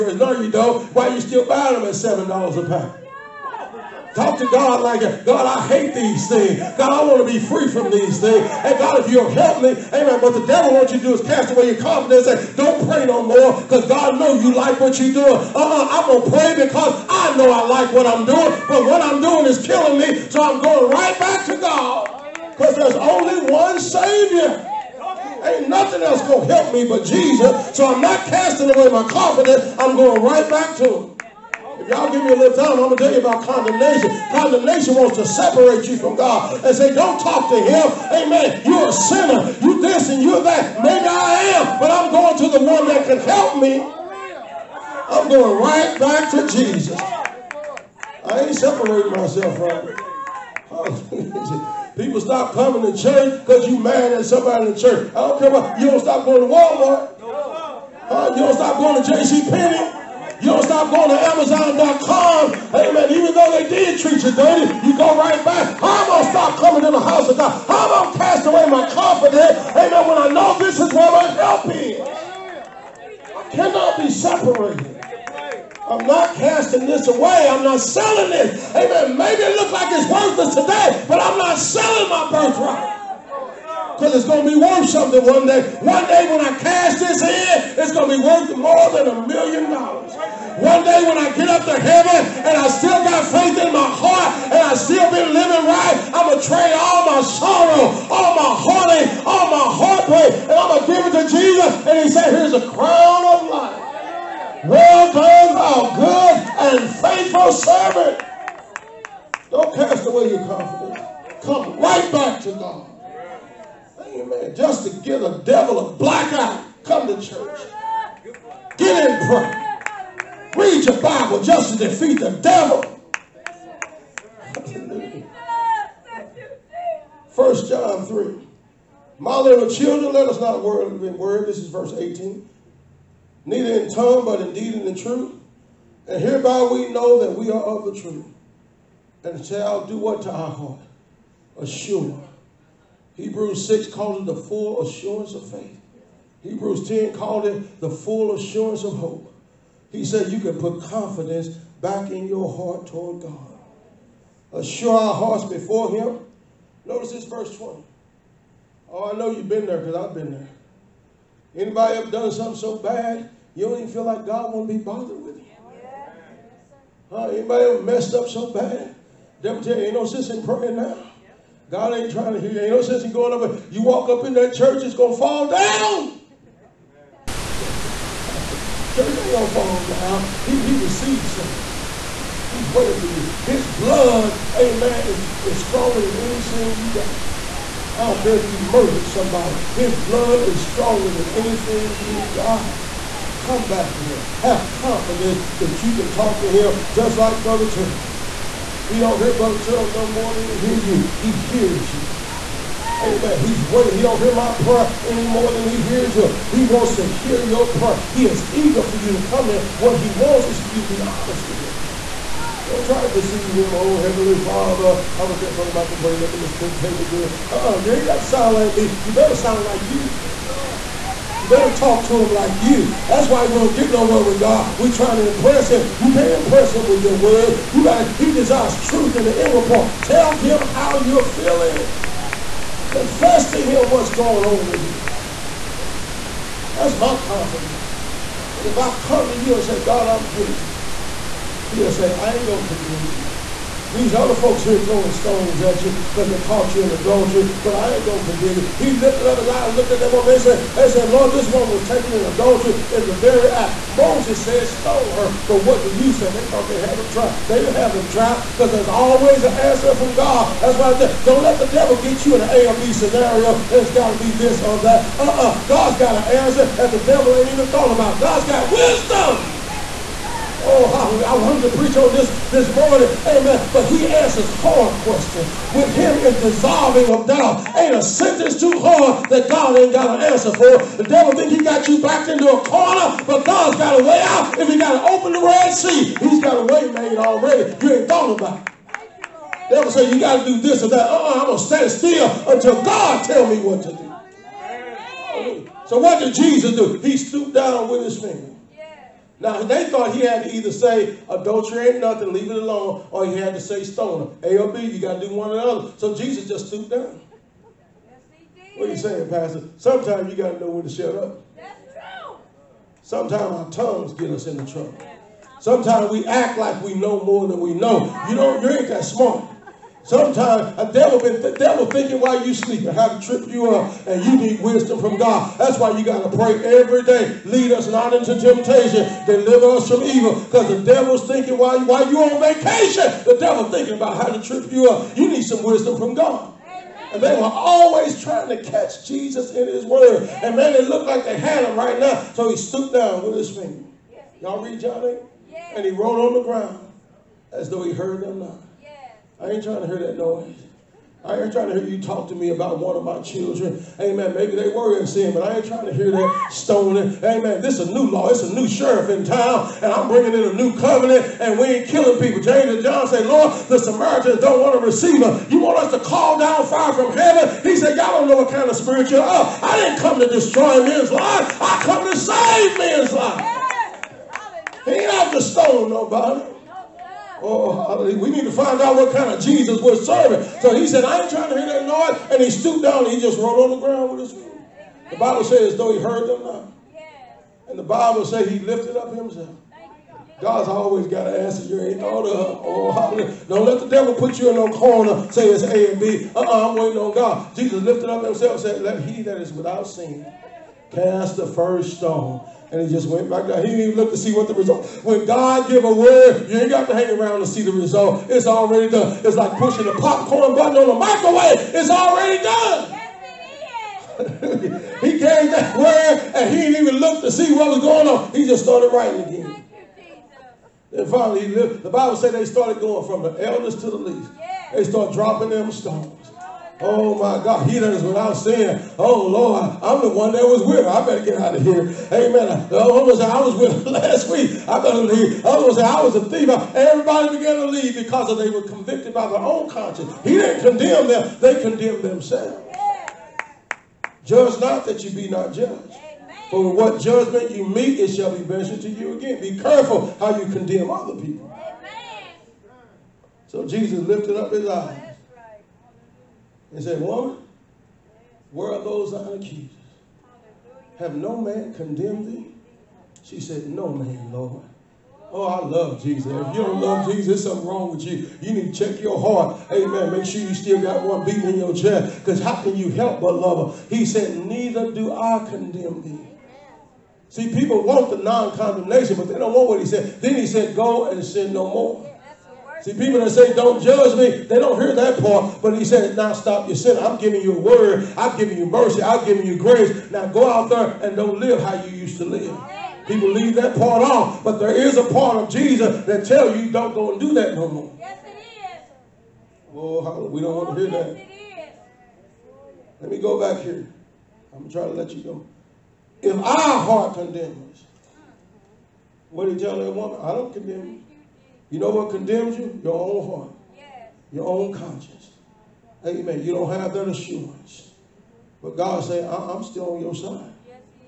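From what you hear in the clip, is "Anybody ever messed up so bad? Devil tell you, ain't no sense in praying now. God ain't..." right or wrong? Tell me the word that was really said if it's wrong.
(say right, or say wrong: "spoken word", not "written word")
right.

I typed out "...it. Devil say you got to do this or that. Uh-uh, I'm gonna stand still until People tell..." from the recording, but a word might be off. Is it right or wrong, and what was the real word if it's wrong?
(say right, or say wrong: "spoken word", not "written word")
wrong: "God", not "People".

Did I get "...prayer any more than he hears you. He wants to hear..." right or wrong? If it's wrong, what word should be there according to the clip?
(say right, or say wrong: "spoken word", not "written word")
right.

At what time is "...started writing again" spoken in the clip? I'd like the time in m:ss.
6:58.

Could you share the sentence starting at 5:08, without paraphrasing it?
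Yes, what are you saying, Pastor?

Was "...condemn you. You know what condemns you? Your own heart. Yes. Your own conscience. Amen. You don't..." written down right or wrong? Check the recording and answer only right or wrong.
right.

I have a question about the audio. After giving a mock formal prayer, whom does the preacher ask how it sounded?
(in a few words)
Brother Michael.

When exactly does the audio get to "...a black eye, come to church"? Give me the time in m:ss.
1:55.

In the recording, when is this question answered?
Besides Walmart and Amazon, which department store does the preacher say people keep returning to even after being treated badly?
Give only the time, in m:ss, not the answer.
0:59.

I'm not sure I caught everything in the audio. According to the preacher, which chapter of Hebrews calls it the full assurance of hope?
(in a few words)
Hebrews 10.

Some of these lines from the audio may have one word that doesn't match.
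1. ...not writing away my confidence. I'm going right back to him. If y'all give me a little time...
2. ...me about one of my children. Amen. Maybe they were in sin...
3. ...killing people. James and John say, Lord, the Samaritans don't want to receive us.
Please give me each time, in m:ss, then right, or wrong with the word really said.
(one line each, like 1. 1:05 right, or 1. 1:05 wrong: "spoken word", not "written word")
1. 0:28 wrong: "casting", not "writing"
2. 5:52 right
3. 6:01 right.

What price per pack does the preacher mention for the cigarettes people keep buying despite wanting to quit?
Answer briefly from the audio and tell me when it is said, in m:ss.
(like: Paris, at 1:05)
$7, at 0:01.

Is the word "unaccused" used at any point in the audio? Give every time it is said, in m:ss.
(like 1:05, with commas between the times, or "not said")
7:39.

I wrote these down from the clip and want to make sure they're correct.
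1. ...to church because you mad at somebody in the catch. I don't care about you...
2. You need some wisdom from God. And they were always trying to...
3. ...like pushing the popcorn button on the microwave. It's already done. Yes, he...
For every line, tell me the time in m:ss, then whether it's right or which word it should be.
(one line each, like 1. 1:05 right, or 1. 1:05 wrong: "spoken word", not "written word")
1. 0:52 wrong: "church", not "catch"
2. 5:35 right
3. 6:49 right.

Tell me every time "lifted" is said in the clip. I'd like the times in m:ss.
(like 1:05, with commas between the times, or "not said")
4:08, 6:28, 6:37, 7:33.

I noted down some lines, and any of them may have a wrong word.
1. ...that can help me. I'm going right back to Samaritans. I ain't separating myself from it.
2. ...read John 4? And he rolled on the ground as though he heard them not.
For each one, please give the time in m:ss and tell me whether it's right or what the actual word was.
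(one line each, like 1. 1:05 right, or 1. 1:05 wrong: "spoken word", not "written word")
1. 0:42 wrong: "Jesus", not "Samaritans"
2. 5:44 wrong: "8", not "4".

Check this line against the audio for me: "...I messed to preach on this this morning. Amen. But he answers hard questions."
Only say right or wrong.
wrong.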